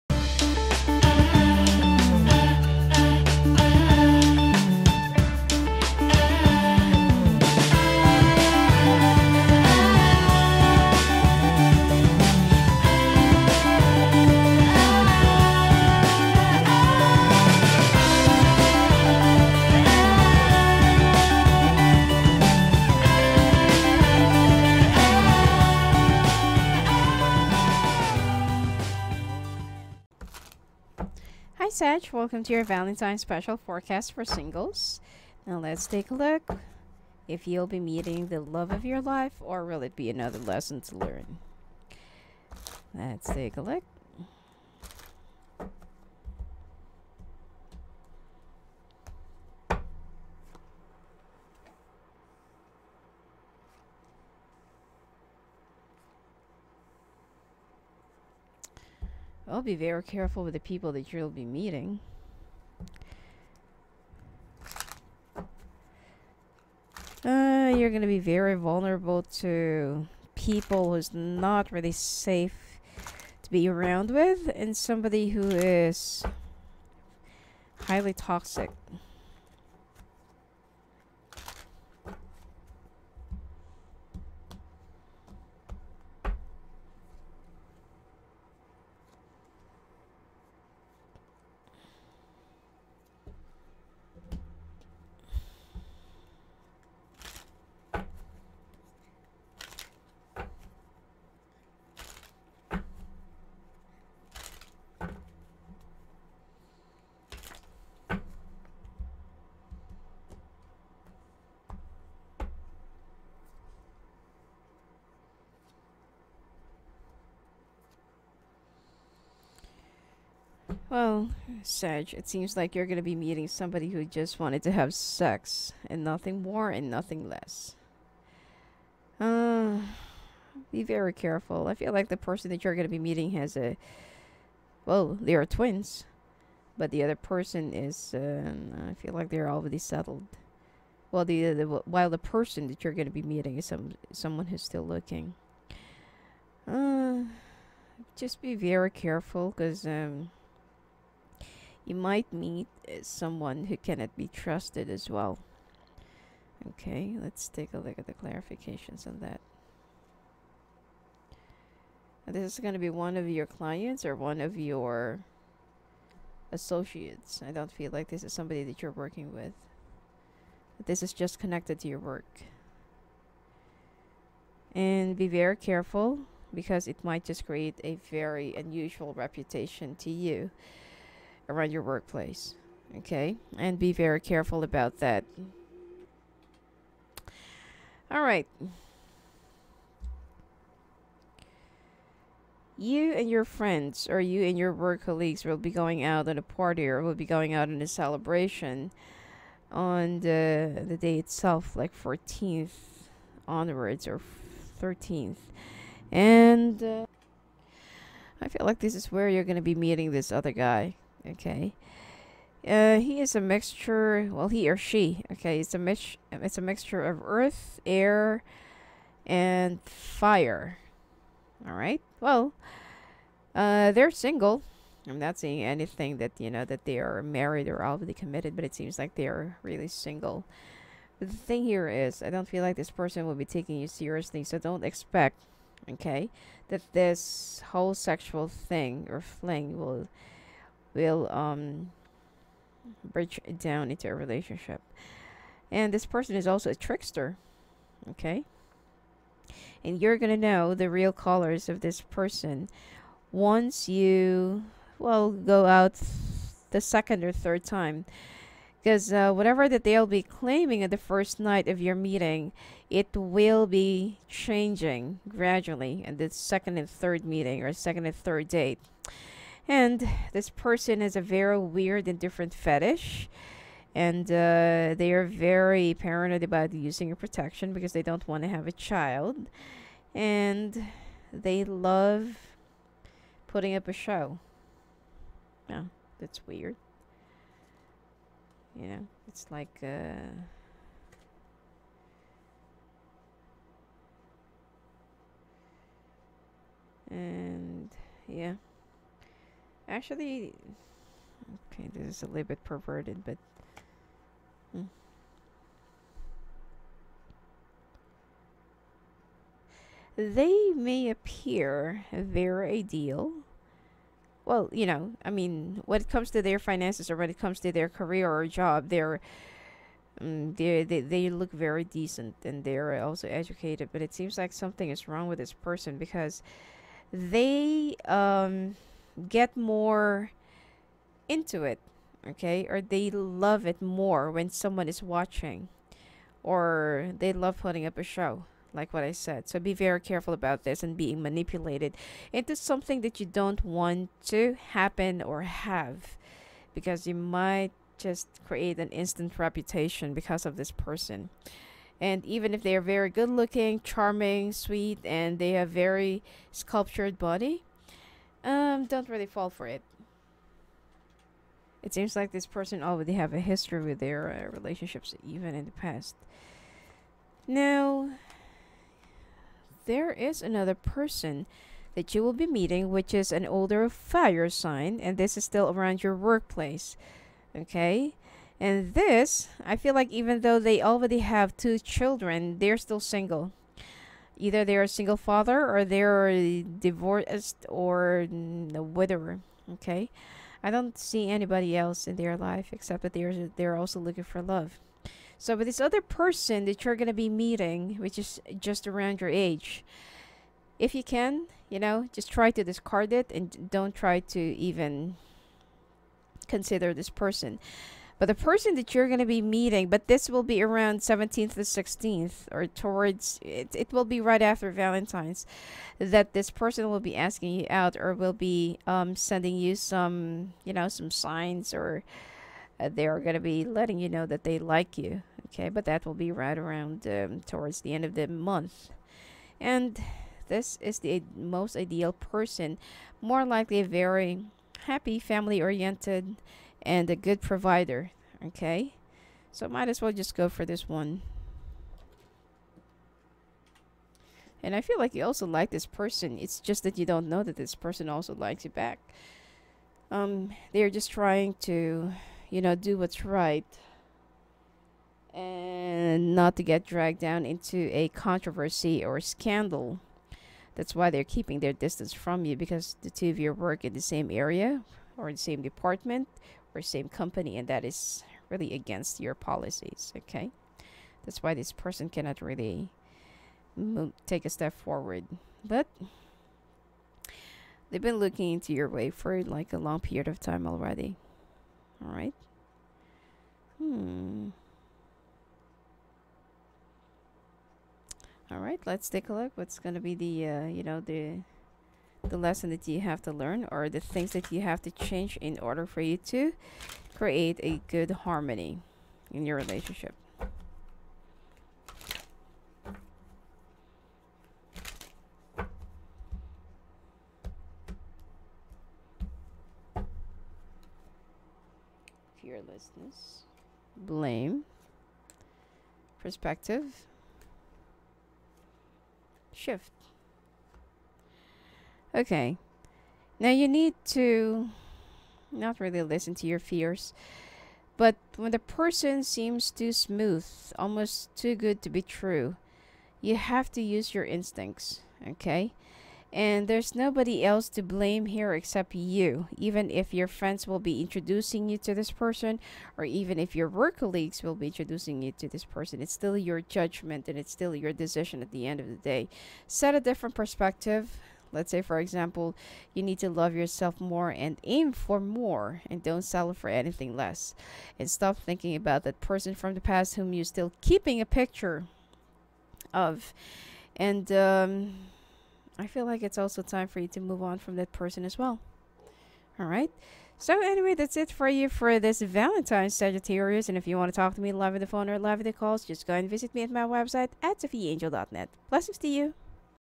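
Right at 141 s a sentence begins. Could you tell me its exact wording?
Well, the, the while the person that you're gonna be meeting is some someone who's still looking.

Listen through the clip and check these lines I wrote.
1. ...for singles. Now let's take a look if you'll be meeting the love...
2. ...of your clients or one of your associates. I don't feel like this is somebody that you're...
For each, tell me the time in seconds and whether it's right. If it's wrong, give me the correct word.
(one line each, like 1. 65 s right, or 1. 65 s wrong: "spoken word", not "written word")
1. 34 s right
2. 163 s right.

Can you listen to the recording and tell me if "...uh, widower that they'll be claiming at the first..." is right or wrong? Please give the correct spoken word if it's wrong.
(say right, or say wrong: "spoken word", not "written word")
wrong: "whatever", not "widower".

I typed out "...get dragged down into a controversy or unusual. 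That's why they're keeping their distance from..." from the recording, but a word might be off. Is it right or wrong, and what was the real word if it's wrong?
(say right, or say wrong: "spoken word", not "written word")
wrong: "scandal", not "unusual".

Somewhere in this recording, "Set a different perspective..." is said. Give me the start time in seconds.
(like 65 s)
549 s.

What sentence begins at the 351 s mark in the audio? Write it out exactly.
And even if they are very good looking, charming, sweet, and they have very sculptured body, um, don't really fall for it.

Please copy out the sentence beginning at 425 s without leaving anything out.
Okay, but that will be right around um, towards the end of the month.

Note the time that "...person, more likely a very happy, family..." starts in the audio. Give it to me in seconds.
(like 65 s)
432 s.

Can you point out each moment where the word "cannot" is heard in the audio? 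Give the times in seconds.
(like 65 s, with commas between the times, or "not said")
153 s, 472 s.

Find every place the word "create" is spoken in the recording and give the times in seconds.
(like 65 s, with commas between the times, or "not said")
177 s, 348 s, 497 s.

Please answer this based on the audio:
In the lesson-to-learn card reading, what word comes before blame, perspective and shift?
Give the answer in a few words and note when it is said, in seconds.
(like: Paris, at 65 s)
Fearlessness, at 512 s.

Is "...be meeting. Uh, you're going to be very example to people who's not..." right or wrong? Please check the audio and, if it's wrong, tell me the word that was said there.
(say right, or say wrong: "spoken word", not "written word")
wrong: "vulnerable", not "example".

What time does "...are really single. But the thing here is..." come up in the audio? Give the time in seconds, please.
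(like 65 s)
229 s.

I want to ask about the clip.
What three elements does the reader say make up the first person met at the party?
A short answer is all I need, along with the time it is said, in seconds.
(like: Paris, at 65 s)
earth, air, and fire, at 217 s.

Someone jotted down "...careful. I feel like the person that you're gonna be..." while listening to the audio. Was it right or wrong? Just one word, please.
right.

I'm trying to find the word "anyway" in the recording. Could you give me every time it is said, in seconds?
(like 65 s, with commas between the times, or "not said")
570 s.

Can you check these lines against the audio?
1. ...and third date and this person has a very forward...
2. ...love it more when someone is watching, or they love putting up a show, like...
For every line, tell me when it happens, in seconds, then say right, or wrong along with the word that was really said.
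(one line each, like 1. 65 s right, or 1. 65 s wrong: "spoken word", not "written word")
1. 268 s wrong: "weird", not "forward"
2. 333 s right.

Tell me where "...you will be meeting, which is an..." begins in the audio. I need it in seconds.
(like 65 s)
372 s.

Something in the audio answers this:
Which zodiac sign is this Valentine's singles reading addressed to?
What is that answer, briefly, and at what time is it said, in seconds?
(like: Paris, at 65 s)
Sagittarius, at 572 s.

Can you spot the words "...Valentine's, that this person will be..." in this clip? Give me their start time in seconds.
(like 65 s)
414 s.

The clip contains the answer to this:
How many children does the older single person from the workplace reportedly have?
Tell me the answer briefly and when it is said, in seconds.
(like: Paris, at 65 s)
2, at 381 s.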